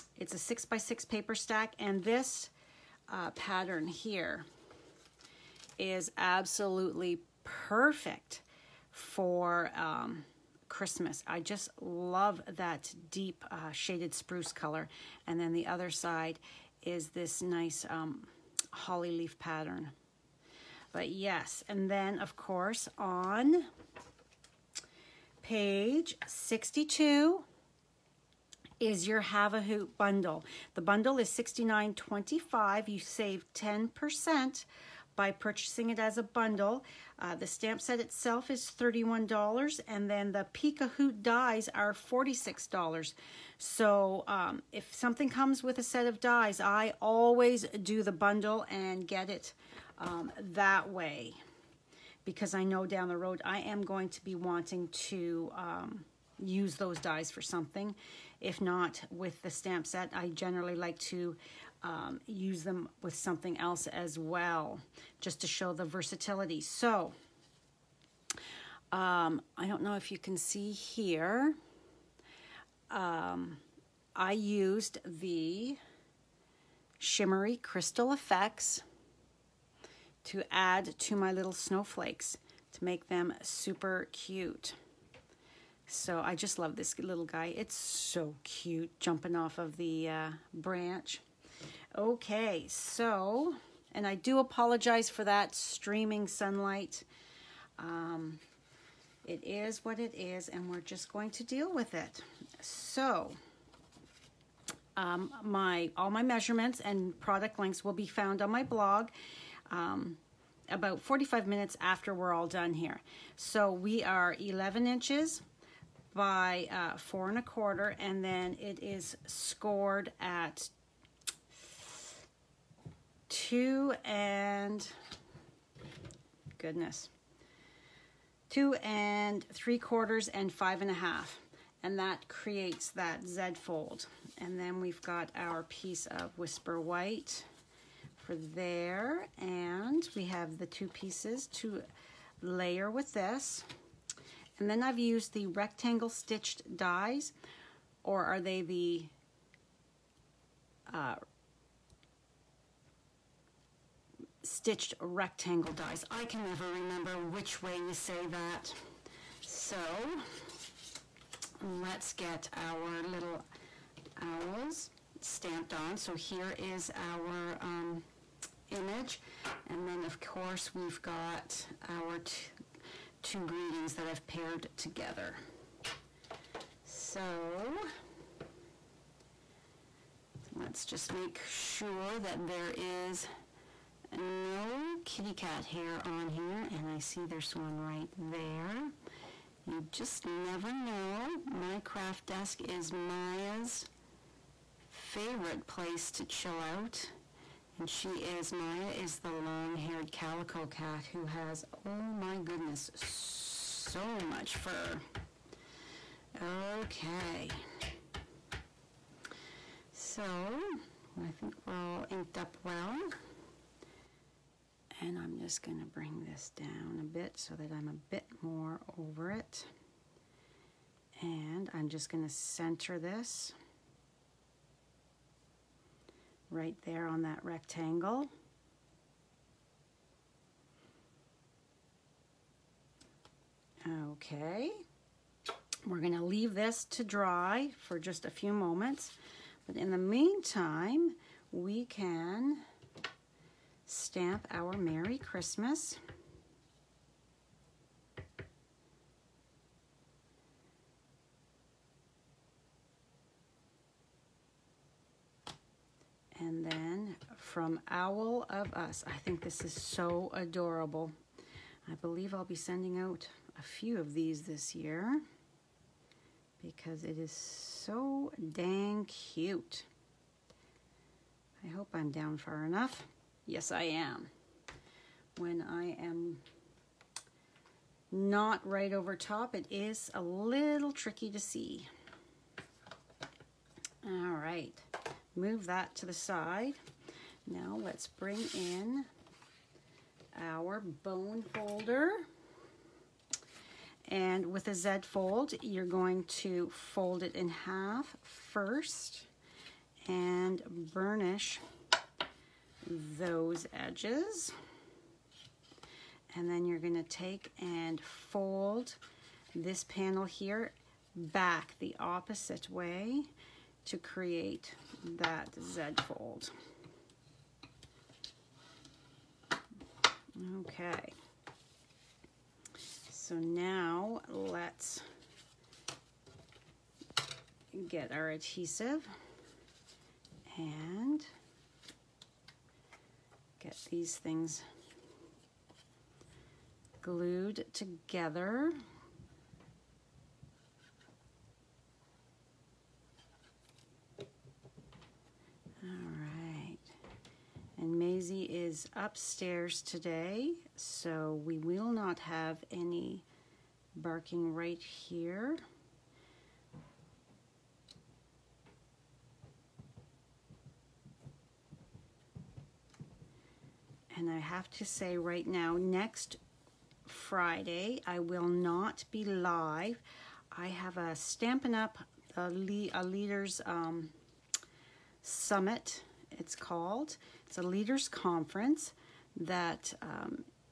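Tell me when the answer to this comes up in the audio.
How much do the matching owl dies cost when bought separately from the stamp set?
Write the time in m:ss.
0:41.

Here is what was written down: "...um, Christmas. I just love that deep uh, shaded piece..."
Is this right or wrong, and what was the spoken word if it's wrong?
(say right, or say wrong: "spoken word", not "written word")
wrong: "spruce", not "piece".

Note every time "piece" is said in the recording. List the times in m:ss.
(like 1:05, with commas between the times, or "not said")
2:15, 2:20.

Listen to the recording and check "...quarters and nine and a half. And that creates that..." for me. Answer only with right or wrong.
wrong.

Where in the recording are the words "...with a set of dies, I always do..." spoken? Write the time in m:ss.
0:45.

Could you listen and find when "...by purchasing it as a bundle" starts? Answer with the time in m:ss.
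0:35.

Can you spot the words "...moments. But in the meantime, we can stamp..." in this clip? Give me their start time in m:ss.
3:58.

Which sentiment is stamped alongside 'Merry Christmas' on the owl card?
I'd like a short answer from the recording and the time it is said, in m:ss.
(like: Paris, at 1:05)
From Owl of Us, at 4:17.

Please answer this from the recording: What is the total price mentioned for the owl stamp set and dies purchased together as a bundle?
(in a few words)
$69.25.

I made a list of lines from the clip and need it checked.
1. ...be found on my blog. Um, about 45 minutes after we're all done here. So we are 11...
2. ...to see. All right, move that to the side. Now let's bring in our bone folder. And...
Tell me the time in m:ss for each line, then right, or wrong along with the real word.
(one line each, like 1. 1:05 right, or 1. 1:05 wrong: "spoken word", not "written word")
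1. 1:47 right
2. 4:41 right.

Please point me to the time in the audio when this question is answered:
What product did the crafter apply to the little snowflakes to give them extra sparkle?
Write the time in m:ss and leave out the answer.
1:16.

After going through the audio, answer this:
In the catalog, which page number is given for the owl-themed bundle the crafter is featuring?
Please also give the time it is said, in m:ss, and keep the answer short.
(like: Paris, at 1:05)
62, at 0:25.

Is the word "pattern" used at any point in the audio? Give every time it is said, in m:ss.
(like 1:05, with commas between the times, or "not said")
0:03, 0:19.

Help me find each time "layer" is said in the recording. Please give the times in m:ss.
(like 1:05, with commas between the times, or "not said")
2:22.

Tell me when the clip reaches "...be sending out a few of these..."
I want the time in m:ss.
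4:22.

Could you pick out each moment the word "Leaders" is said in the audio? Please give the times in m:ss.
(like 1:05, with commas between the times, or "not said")
6:13, 6:17.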